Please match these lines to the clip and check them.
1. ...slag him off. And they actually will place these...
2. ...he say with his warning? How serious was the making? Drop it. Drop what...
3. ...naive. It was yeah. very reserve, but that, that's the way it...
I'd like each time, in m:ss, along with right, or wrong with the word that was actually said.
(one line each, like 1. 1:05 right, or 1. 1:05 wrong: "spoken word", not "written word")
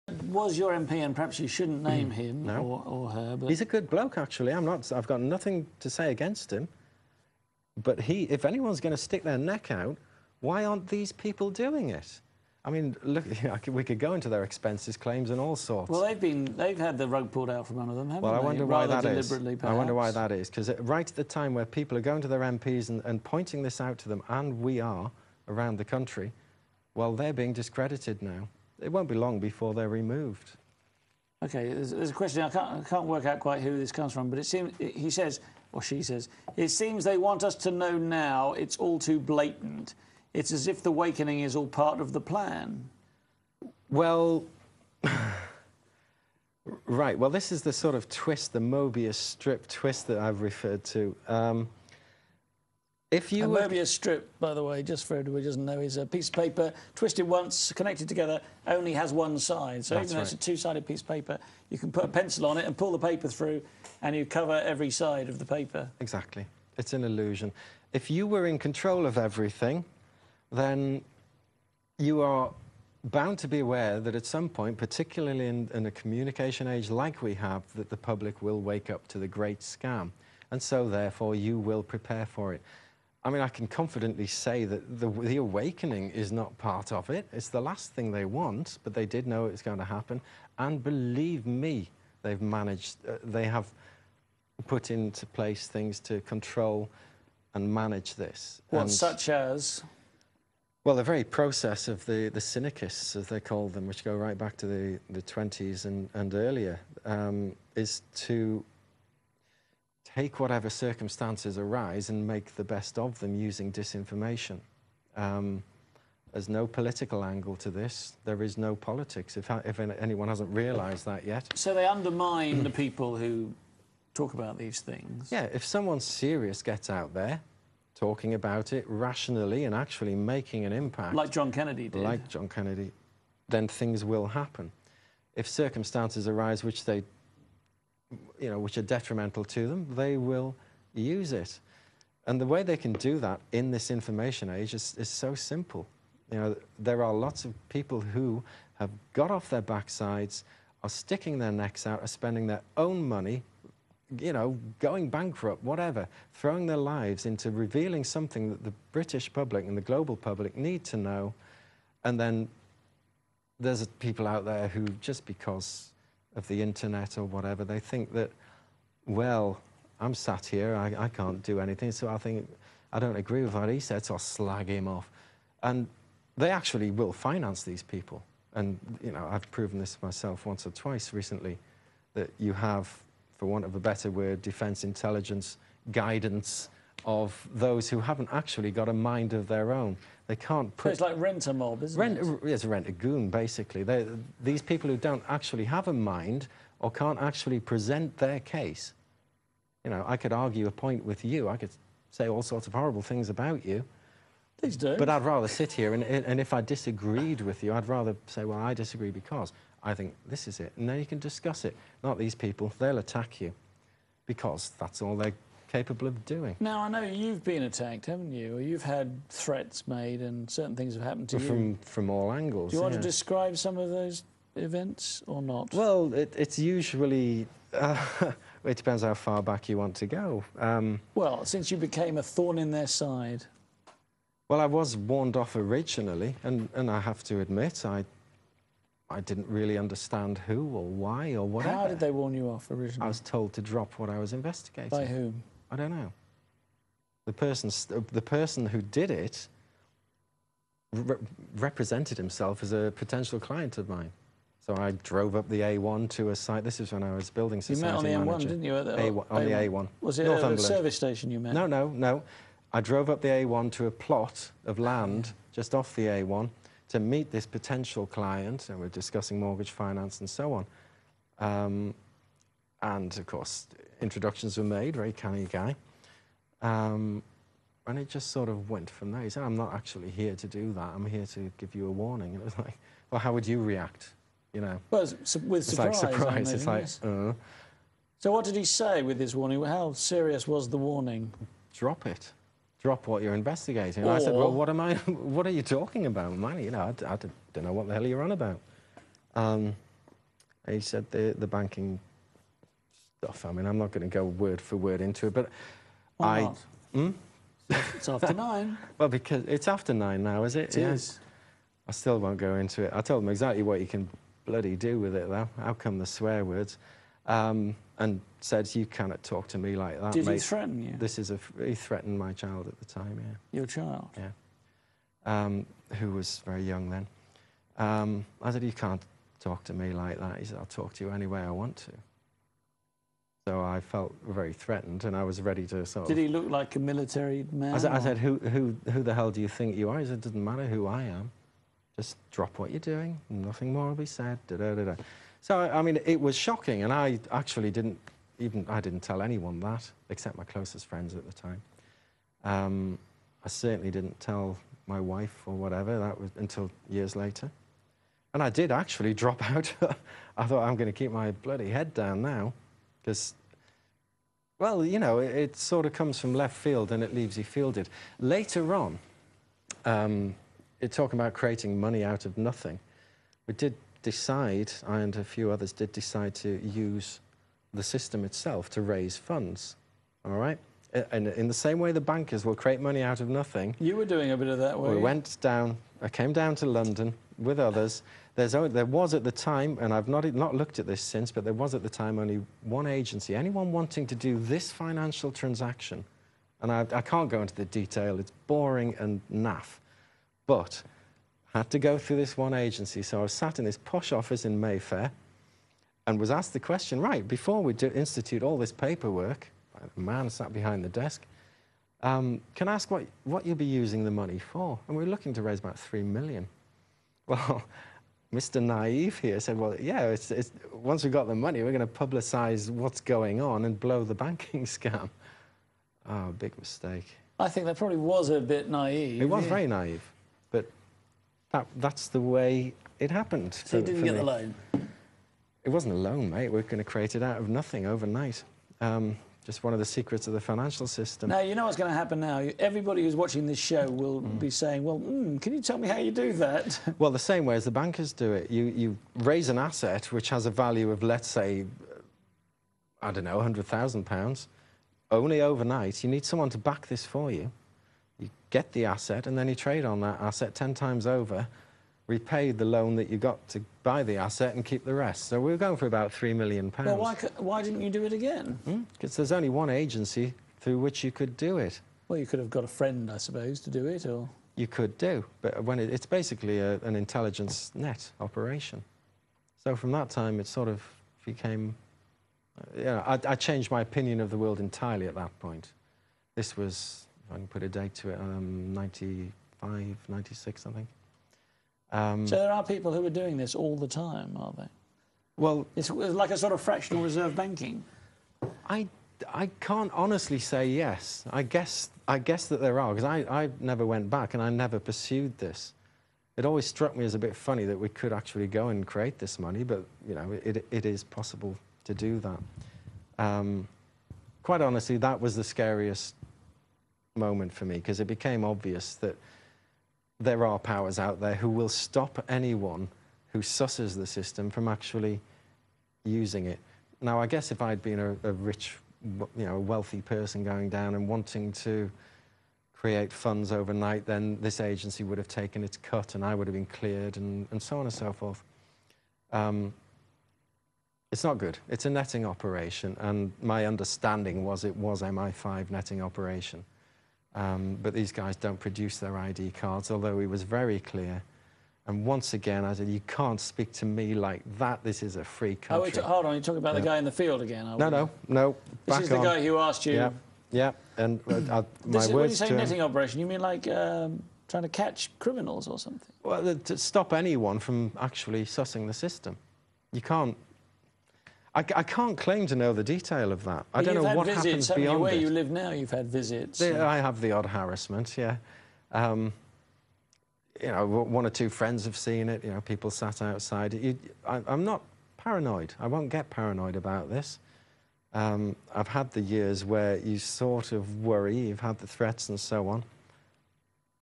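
1. 2:54 wrong: "finance", not "place"
2. 4:48 wrong: "warning", not "making"
3. 7:08 wrong: "naive", not "reserve".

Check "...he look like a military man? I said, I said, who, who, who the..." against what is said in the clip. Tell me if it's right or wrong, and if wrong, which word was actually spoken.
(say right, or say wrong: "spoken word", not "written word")
right.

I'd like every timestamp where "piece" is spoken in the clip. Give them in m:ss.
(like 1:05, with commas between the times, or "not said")
0:56, 1:00.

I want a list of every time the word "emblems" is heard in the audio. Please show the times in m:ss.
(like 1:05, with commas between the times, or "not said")
not said.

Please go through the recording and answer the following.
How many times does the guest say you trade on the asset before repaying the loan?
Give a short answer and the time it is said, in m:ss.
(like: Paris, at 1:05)
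10 times, at 7:40.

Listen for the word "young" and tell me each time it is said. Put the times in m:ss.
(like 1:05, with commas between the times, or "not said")
5:26.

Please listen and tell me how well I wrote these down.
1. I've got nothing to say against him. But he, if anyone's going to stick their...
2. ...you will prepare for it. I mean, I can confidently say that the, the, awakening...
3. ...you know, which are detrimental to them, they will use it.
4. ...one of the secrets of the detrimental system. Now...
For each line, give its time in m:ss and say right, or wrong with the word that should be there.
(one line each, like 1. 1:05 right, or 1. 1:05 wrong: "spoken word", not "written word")
1. 0:04 right
2. 1:21 right
3. 2:18 right
4. 7:19 wrong: "financial", not "detrimental".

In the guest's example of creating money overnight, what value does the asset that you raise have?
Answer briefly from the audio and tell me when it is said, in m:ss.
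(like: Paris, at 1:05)
£100,000, at 7:33.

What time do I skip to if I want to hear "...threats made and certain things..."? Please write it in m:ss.
3:39.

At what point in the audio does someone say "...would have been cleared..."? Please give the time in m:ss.
8:56.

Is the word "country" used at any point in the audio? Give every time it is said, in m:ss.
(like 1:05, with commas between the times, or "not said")
0:25, 9:15.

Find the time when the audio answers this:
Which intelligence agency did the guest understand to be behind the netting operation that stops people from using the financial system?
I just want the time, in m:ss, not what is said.
9:05.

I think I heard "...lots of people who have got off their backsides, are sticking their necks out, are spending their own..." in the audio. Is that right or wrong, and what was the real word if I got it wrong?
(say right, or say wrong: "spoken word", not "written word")
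right.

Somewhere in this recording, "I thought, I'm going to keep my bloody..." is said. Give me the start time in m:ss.
6:00.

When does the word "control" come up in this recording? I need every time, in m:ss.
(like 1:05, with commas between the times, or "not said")
1:08, 1:36.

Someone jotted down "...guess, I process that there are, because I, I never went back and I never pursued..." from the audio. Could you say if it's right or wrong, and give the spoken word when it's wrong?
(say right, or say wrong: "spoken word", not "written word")
wrong: "guess", not "process".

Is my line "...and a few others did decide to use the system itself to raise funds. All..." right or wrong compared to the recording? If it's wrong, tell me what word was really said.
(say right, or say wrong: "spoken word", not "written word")
right.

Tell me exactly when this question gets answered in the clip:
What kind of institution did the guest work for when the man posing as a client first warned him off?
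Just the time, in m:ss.
4:17.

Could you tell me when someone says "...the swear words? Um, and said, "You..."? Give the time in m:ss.
5:15.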